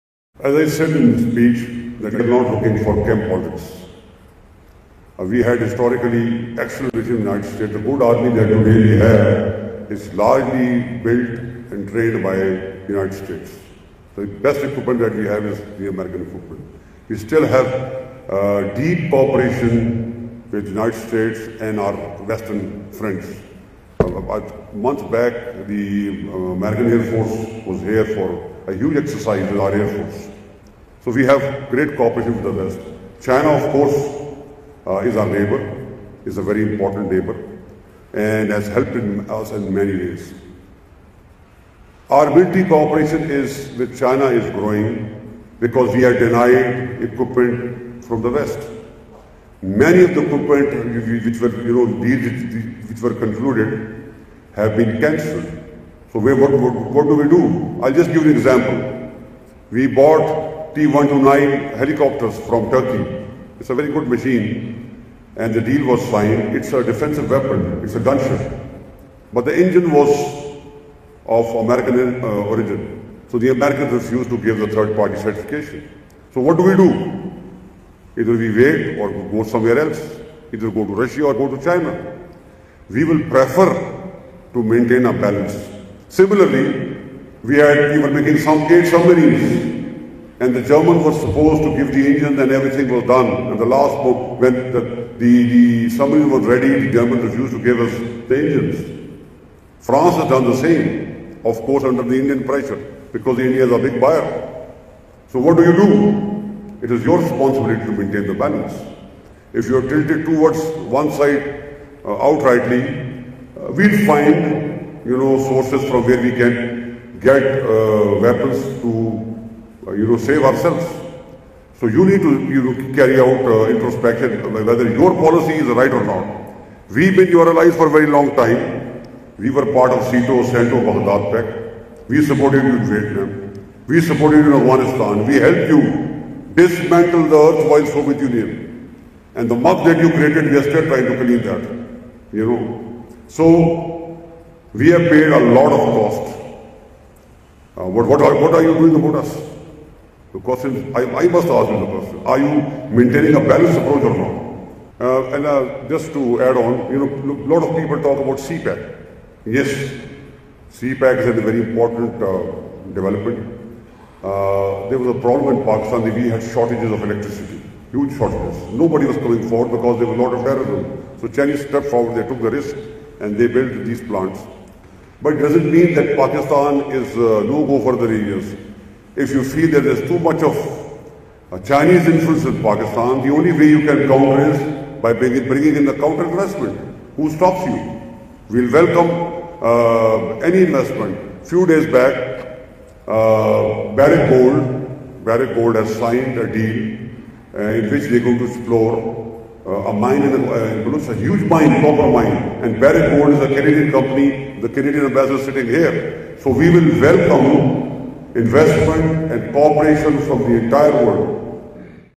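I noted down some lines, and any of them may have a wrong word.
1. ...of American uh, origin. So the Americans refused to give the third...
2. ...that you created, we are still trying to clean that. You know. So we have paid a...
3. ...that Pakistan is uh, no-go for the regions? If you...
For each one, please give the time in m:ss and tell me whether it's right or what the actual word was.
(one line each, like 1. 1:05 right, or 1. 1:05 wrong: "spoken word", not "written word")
1. 1:11 right
2. 2:19 right
3. 2:55 right.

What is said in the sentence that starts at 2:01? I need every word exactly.
So you need to you know, carry out uh, introspection uh, whether your policy is right or not.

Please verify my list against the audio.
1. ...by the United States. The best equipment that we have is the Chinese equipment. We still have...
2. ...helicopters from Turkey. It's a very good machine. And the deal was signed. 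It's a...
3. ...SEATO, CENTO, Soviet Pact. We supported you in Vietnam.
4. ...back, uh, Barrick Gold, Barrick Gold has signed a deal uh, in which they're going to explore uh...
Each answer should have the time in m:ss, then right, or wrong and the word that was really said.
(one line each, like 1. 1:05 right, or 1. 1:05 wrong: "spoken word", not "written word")
1. 0:12 wrong: "American", not "Chinese"
2. 1:01 right
3. 2:10 wrong: "Baghdad", not "Soviet"
4. 3:11 right.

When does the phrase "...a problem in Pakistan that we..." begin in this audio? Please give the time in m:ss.
2:45.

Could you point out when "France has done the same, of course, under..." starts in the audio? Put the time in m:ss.
1:39.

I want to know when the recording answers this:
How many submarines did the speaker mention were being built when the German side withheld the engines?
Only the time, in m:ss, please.
1:28.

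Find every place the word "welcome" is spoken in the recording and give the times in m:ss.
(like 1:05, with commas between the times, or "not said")
3:08, 3:26.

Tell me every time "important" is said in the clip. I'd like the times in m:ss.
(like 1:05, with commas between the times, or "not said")
0:36, 2:41.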